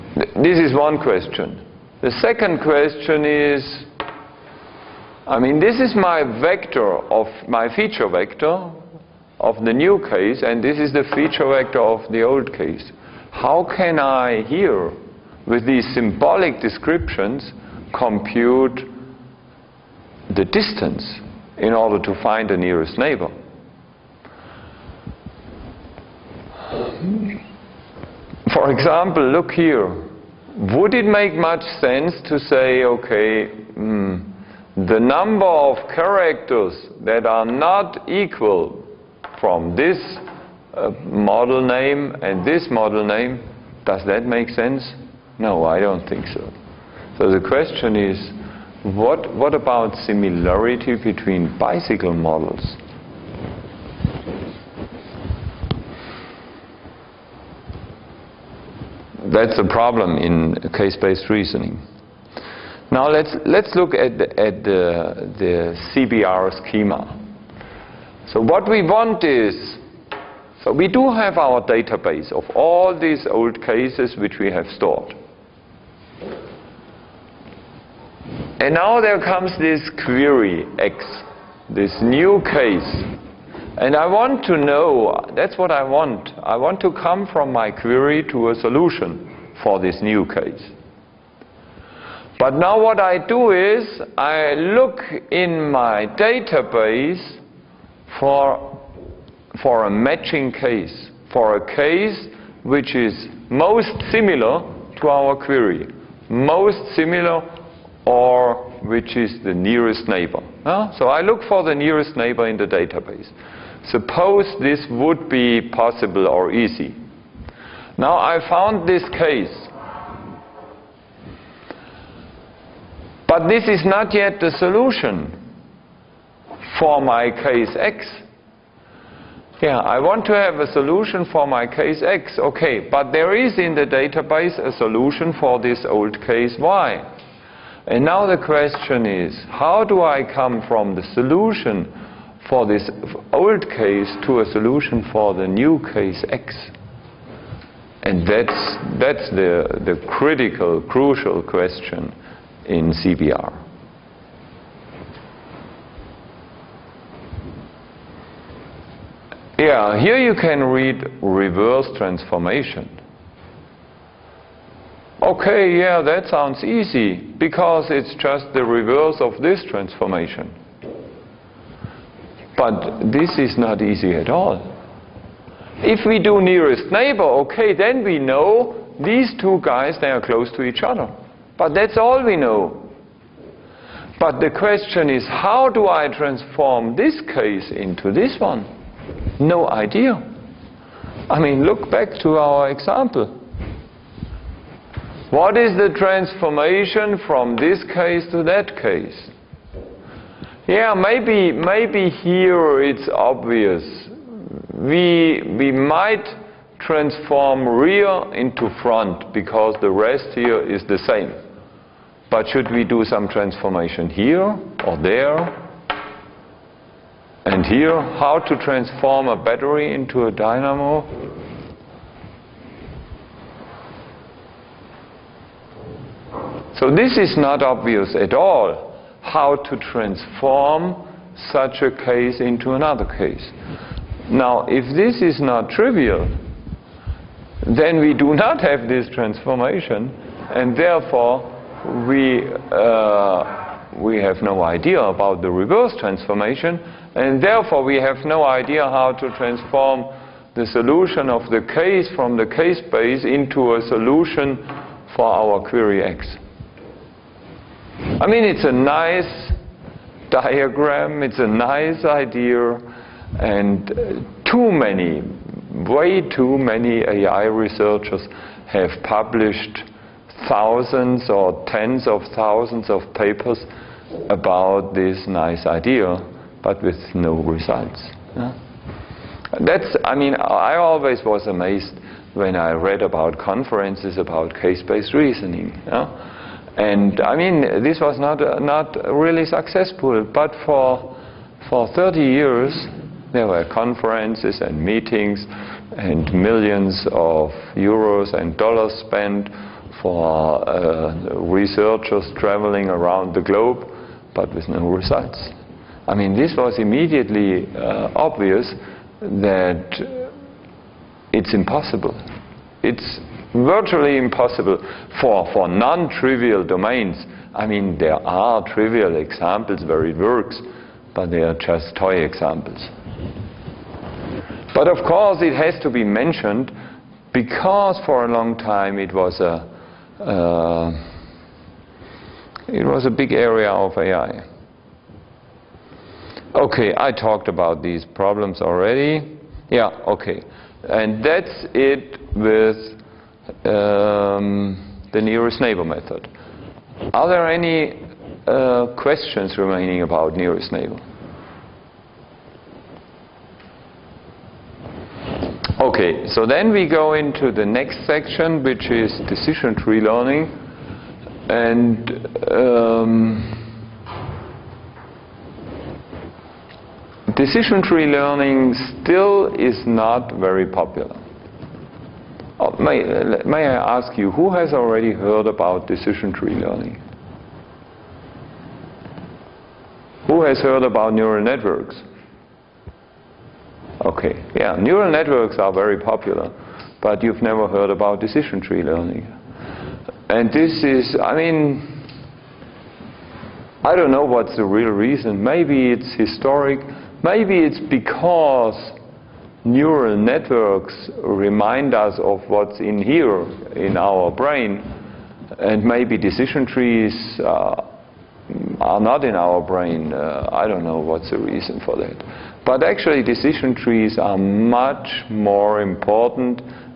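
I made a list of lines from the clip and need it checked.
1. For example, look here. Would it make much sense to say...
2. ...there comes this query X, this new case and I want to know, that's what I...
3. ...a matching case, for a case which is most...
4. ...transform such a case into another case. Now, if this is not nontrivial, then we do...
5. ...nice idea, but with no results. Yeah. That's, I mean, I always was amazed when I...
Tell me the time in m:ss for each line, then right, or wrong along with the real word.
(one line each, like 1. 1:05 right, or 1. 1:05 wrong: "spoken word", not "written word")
1. 0:28 right
2. 1:18 right
3. 1:39 right
4. 3:49 wrong: "trivial", not "nontrivial"
5. 4:35 right.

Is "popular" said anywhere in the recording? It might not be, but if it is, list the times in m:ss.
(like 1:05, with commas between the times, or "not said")
6:10, 6:25.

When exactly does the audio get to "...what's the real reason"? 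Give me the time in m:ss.
6:34.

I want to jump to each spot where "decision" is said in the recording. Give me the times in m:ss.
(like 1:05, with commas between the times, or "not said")
5:59, 6:07, 6:15, 6:28, 6:46, 6:53.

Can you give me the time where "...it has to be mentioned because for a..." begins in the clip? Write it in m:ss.
5:25.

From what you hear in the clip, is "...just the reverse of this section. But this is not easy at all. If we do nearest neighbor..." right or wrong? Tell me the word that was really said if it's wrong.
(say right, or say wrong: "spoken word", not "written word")
wrong: "transformation", not "section".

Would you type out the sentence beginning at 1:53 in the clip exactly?
Suppose this would be possible or easy.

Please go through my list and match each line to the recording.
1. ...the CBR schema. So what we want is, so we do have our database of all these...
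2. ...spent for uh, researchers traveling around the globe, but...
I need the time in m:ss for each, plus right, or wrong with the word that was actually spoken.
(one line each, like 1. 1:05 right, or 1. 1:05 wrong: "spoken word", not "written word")
1. 1:05 right
2. 4:59 right.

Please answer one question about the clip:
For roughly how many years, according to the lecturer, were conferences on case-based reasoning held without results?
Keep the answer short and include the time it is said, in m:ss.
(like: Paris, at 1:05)
30 years, at 4:51.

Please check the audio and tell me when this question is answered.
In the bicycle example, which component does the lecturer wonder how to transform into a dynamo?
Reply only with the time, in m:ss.
3:39.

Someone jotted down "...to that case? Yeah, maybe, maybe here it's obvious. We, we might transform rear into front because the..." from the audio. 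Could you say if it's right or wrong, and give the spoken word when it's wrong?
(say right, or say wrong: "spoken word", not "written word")
right.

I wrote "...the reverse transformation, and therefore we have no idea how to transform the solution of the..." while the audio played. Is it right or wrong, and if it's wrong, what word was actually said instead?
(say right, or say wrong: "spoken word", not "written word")
right.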